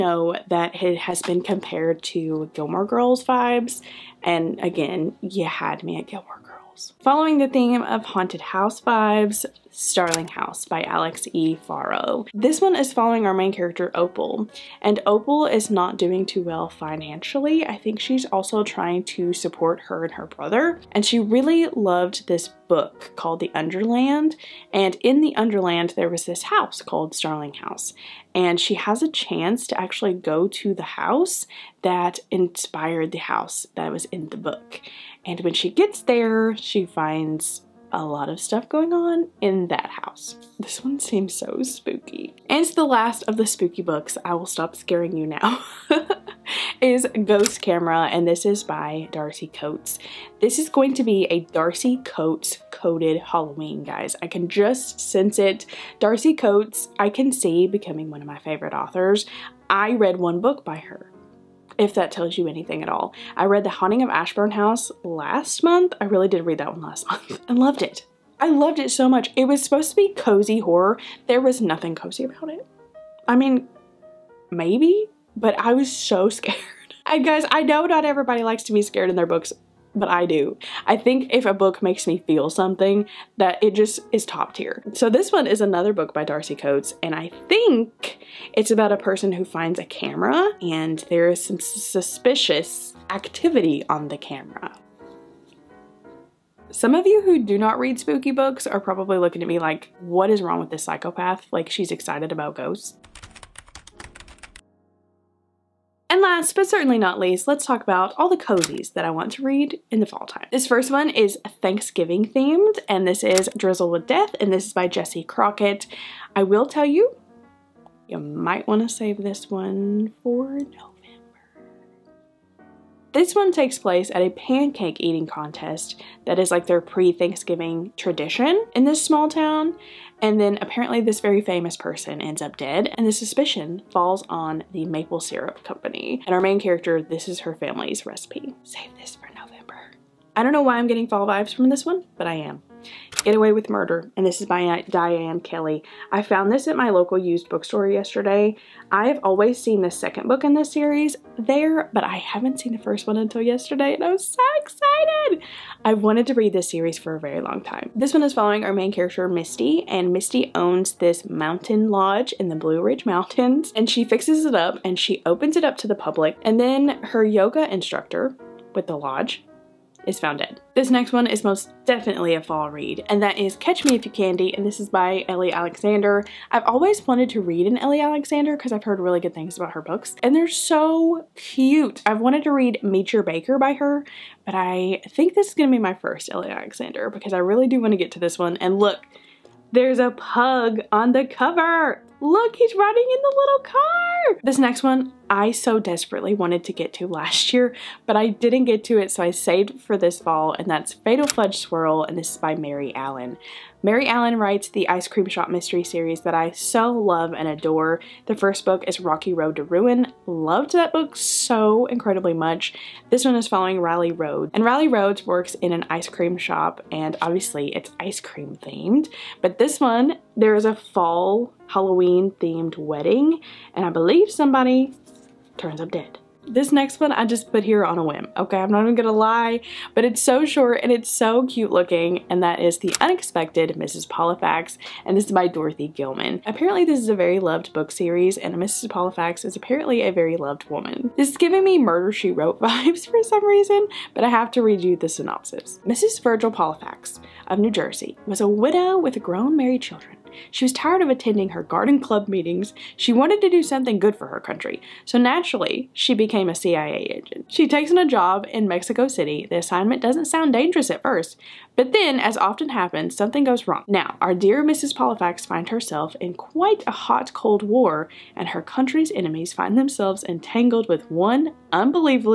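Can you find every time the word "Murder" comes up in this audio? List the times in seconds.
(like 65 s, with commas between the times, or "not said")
143 s, 241 s.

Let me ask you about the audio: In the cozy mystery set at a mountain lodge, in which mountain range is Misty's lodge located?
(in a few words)
Blue Ridge Mountains.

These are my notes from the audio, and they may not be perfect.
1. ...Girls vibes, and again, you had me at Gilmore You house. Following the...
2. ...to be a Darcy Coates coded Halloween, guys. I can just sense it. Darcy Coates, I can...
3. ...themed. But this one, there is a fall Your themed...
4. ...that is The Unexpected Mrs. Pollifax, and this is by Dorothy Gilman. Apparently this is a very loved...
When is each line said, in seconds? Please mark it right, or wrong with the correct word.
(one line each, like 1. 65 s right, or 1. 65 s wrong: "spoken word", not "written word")
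1. 2 s wrong: "Girls", not "You"
2. 50 s right
3. 218 s wrong: "Halloween", not "Your"
4. 232 s right.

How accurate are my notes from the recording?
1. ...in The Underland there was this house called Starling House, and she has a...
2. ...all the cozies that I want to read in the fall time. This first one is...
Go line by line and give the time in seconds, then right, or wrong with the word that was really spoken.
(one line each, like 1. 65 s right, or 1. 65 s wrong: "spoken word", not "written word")
1. 24 s right
2. 108 s right.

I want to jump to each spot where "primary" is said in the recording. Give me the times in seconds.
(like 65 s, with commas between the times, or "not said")
not said.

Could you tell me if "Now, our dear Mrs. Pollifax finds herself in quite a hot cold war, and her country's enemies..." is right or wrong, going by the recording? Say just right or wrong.
right.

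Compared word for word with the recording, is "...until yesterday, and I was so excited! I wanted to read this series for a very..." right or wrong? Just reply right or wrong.
right.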